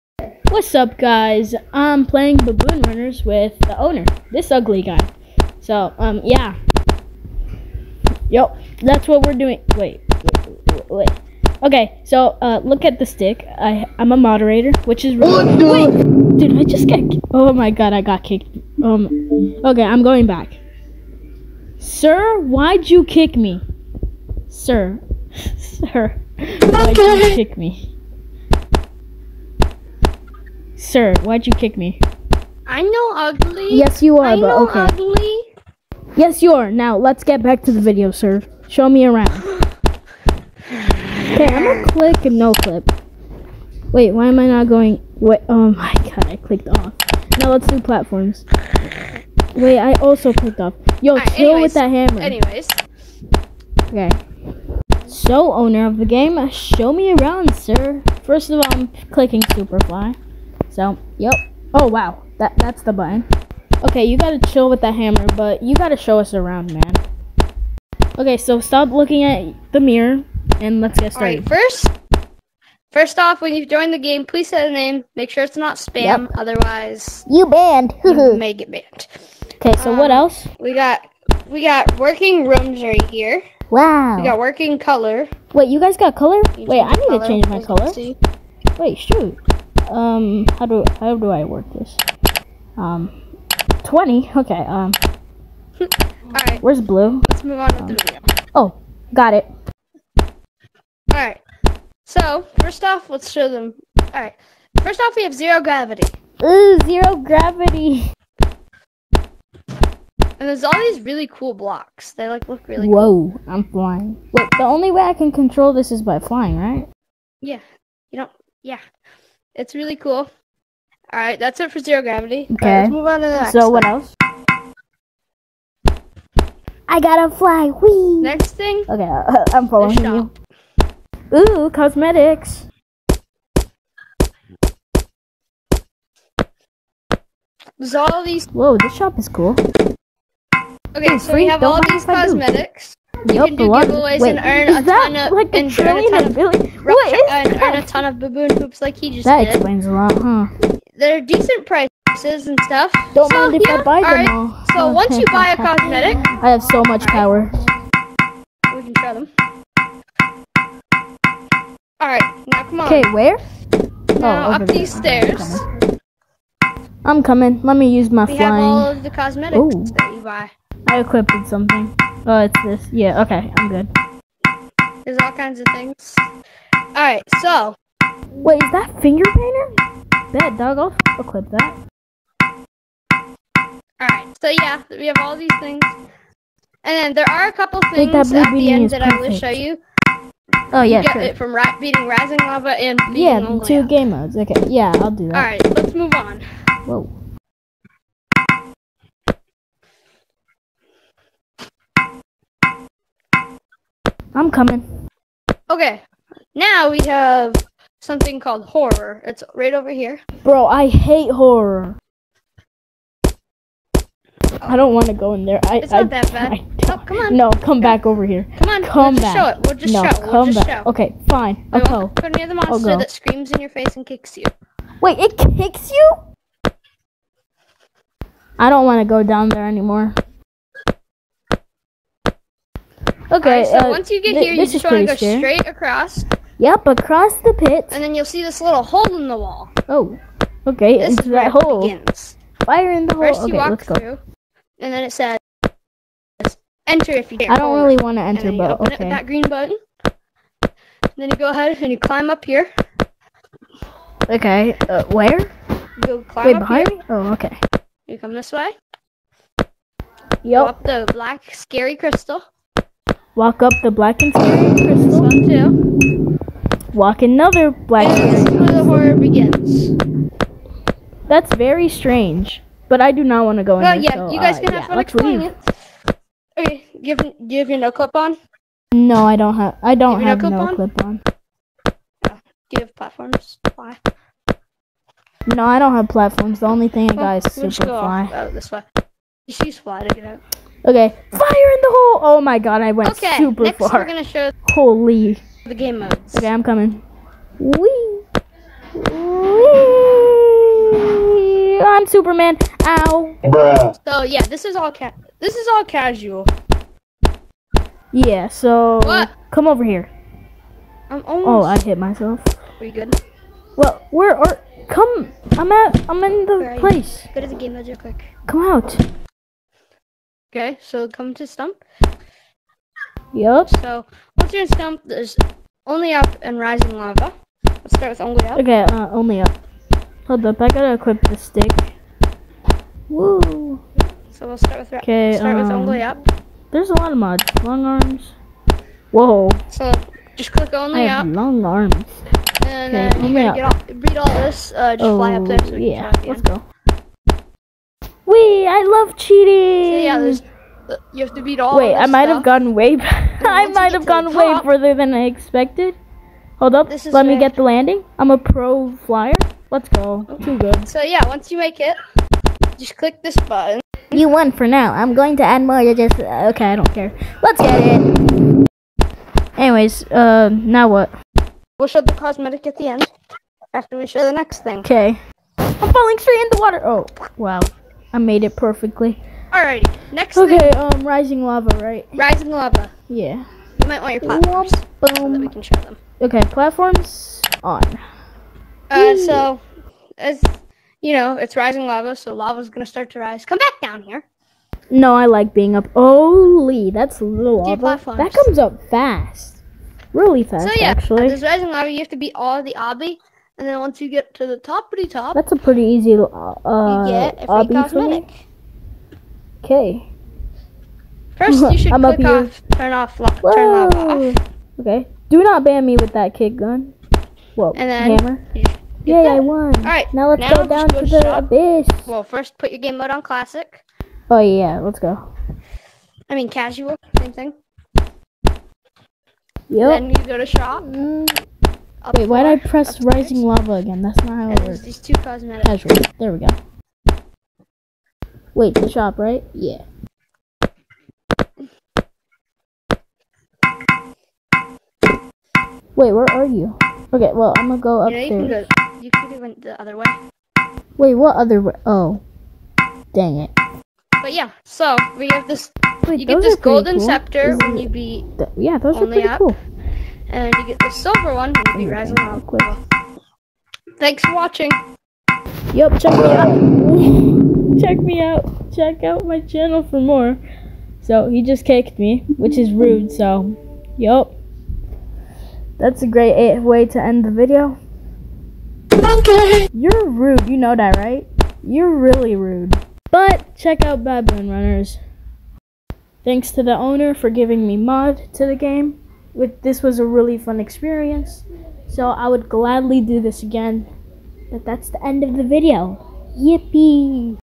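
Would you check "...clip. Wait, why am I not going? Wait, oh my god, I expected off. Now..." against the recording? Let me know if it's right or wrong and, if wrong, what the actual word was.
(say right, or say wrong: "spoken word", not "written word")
wrong: "clicked", not "expected".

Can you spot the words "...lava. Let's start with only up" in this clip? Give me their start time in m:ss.
5:26.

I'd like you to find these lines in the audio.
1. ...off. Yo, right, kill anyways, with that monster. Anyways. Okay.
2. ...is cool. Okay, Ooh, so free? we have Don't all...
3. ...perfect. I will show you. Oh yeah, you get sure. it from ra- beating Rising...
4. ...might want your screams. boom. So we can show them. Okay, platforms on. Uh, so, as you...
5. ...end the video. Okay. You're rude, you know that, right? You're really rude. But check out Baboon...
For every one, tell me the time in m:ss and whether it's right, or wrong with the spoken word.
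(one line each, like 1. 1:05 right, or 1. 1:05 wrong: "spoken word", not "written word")
1. 0:50 wrong: "hammer", not "monster"
2. 2:19 right
3. 3:09 right
4. 6:23 wrong: "platforms", not "screams"
5. 7:57 right.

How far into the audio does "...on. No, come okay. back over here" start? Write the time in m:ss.
3:37.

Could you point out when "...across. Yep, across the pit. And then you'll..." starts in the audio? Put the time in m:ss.
3:55.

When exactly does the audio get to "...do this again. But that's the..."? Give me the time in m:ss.
8:13.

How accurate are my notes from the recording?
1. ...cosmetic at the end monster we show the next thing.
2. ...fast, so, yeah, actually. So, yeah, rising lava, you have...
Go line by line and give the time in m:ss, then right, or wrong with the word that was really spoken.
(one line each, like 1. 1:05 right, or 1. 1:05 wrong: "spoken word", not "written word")
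1. 6:12 wrong: "after", not "monster"
2. 6:40 right.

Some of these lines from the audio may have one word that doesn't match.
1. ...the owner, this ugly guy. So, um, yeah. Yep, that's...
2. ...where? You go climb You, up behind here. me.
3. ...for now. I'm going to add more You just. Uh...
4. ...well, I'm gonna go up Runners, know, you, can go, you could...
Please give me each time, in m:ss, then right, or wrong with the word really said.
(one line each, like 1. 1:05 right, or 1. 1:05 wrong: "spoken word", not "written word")
1. 0:03 right
2. 4:15 wrong: "Wait", not "You"
3. 6:04 right
4. 7:27 wrong: "You", not "Runners".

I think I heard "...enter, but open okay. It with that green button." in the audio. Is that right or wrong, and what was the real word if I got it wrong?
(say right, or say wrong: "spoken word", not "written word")
right.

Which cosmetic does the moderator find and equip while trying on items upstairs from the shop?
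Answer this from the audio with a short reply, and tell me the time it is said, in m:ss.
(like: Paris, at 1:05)
finger painter, at 2:59.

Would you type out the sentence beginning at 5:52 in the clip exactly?
I might have gone way further than I expected.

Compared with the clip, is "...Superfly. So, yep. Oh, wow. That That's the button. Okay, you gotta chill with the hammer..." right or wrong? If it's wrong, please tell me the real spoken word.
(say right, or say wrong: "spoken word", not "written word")
right.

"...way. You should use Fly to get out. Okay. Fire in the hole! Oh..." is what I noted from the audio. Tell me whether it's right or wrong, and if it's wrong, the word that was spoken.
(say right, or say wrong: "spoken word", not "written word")
right.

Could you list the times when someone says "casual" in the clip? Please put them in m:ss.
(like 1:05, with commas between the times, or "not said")
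5:05, 7:06, 7:15.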